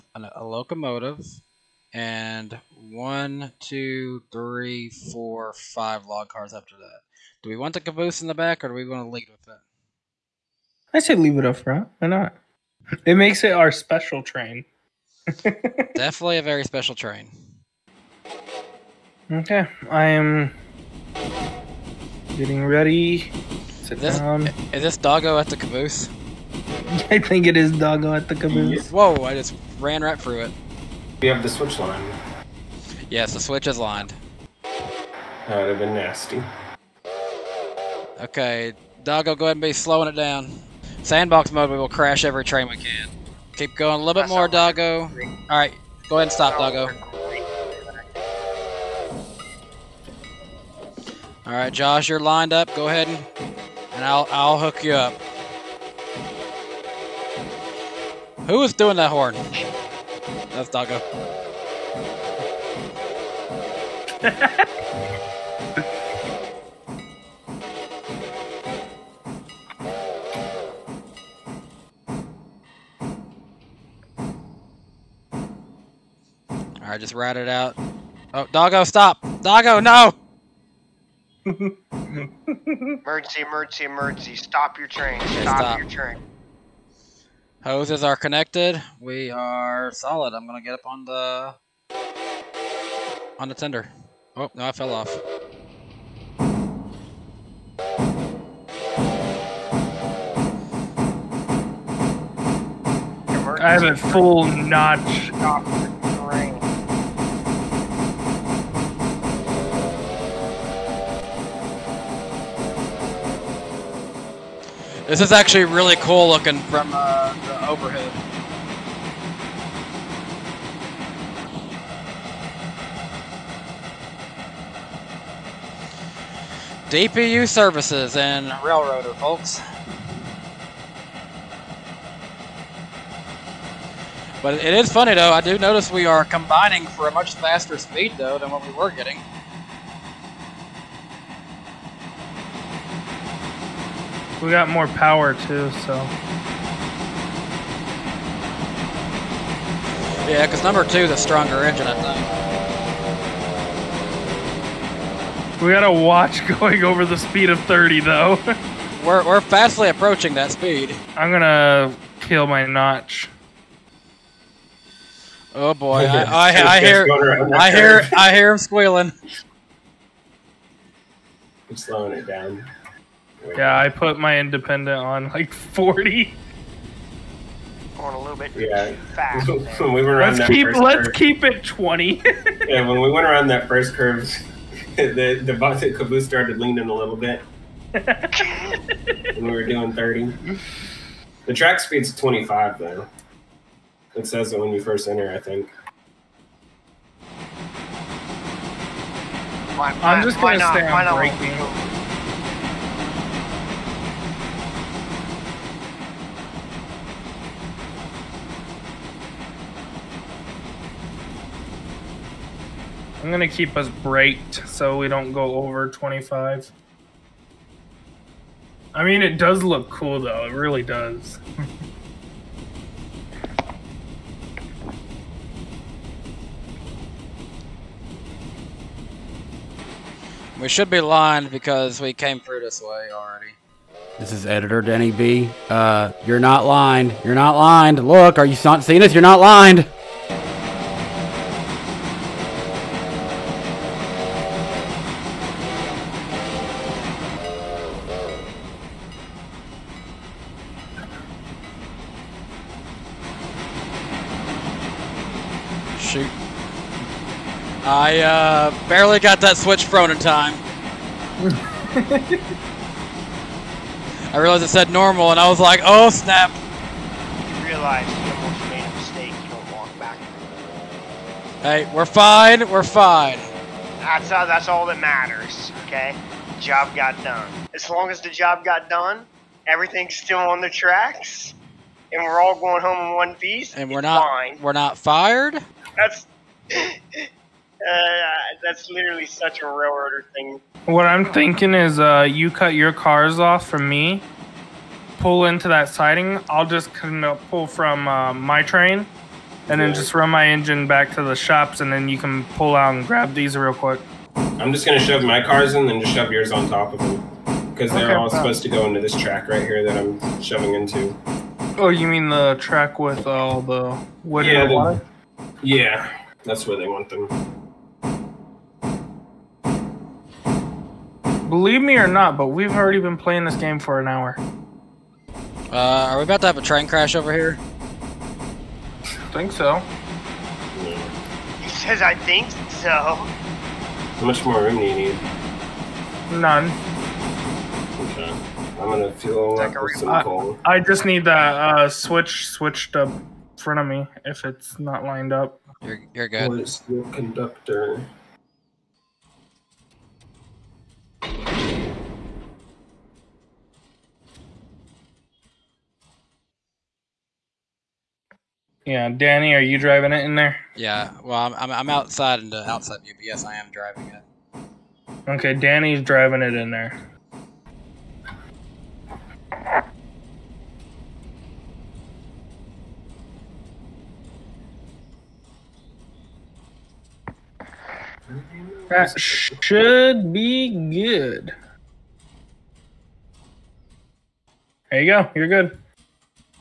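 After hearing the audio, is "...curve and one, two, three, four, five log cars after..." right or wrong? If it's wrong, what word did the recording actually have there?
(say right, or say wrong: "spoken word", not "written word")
wrong: "locomotive", not "curve".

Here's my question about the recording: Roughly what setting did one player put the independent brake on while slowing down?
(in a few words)
40.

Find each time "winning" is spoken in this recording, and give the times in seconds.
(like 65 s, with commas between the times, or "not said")
not said.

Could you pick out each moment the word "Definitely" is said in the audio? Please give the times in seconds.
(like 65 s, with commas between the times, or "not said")
15 s.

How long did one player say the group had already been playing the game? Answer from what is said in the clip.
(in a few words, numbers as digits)
an hour.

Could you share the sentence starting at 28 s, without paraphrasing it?
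Whoa, I just ran right through it.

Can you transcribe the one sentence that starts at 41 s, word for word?
Sandbox mode, we will crash every train we can.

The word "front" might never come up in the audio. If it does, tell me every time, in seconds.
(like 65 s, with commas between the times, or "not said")
11 s, 343 s.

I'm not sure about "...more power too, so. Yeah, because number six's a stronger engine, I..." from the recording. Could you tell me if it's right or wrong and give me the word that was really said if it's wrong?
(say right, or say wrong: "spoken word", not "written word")
wrong: "two", not "six".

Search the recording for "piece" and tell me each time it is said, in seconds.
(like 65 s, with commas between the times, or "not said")
283 s.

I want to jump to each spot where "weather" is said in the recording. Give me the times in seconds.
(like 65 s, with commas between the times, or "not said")
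not said.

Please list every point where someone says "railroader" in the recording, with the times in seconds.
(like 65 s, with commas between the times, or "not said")
128 s, 289 s.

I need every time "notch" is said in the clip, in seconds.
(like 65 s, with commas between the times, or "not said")
104 s, 162 s.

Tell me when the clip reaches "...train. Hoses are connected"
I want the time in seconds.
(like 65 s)
85 s.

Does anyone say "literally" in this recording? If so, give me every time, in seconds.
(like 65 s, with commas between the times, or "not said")
288 s.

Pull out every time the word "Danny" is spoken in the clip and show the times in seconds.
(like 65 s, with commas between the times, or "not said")
234 s, 359 s, 365 s.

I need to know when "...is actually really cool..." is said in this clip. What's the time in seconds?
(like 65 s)
115 s.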